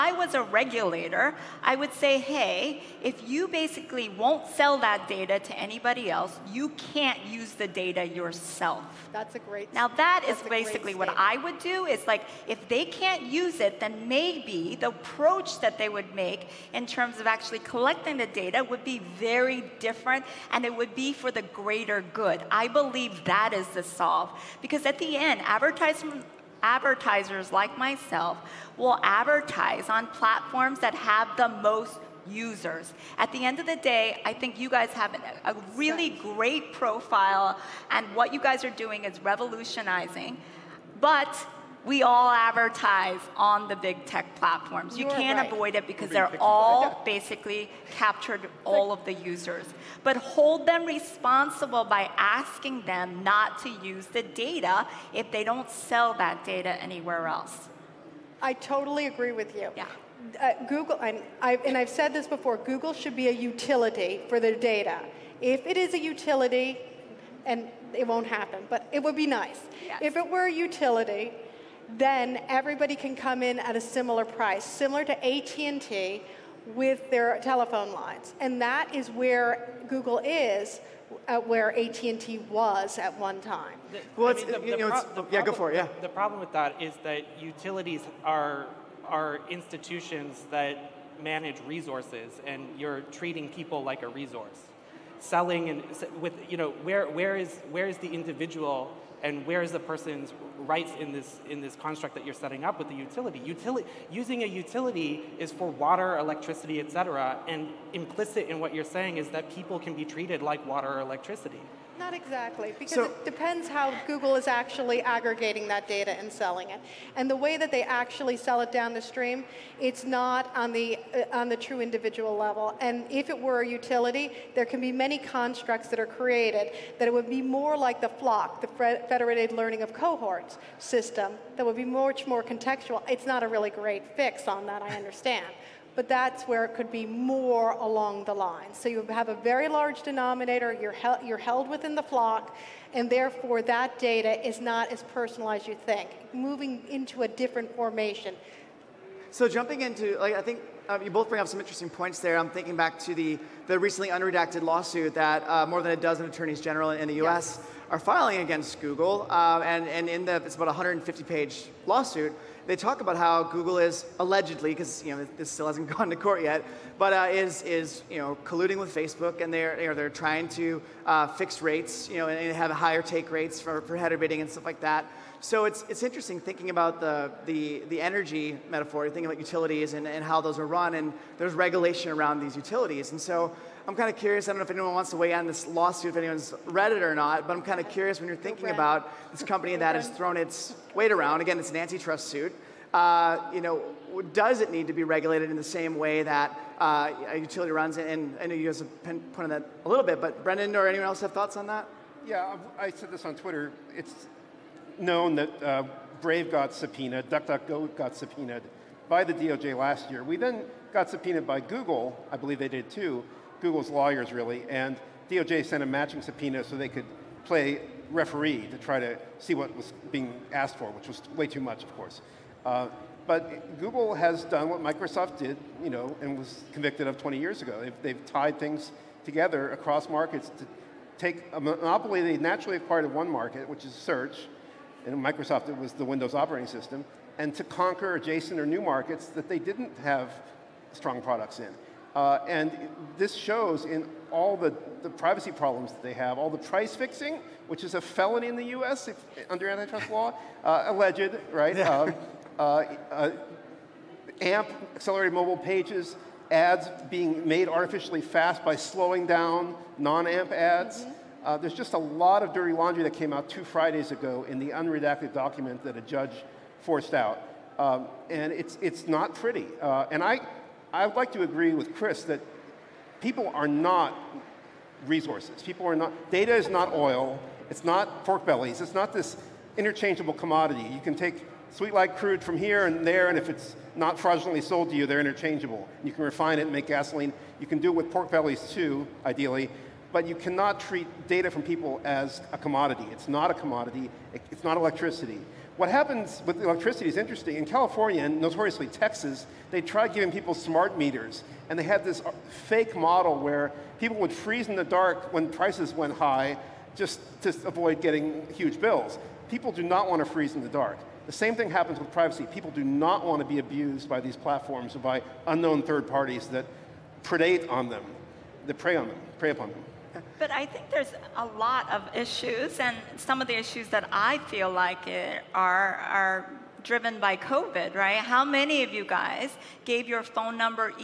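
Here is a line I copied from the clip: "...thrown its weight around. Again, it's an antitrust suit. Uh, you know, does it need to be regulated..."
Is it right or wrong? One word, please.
right.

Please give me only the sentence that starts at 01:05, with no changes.
If it is a utility, and it won't happen, but it would be nice.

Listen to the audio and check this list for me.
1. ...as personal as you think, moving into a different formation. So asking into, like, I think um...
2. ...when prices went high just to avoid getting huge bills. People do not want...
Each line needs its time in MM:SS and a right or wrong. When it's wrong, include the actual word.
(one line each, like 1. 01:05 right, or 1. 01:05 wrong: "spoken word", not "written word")
1. 02:24 wrong: "jumping", not "asking"
2. 05:05 right.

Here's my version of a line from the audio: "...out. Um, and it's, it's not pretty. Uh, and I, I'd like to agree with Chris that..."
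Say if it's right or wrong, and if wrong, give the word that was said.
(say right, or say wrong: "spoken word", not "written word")
right.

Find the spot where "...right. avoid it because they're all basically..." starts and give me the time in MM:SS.
00:45.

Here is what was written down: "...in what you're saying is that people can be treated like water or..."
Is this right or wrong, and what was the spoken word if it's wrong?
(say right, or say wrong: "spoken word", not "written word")
right.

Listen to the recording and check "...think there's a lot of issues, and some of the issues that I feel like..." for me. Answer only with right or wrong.
right.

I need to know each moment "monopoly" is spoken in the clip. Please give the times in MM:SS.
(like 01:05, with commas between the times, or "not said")
03:51.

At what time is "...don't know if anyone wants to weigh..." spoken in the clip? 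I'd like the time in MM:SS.
03:04.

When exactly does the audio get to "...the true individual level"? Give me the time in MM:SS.
02:01.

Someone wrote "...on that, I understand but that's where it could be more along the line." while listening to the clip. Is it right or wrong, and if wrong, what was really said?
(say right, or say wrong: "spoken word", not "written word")
right.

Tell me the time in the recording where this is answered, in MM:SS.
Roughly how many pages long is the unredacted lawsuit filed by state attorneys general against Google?
02:40.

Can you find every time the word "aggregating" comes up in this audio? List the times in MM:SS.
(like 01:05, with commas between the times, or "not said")
01:55.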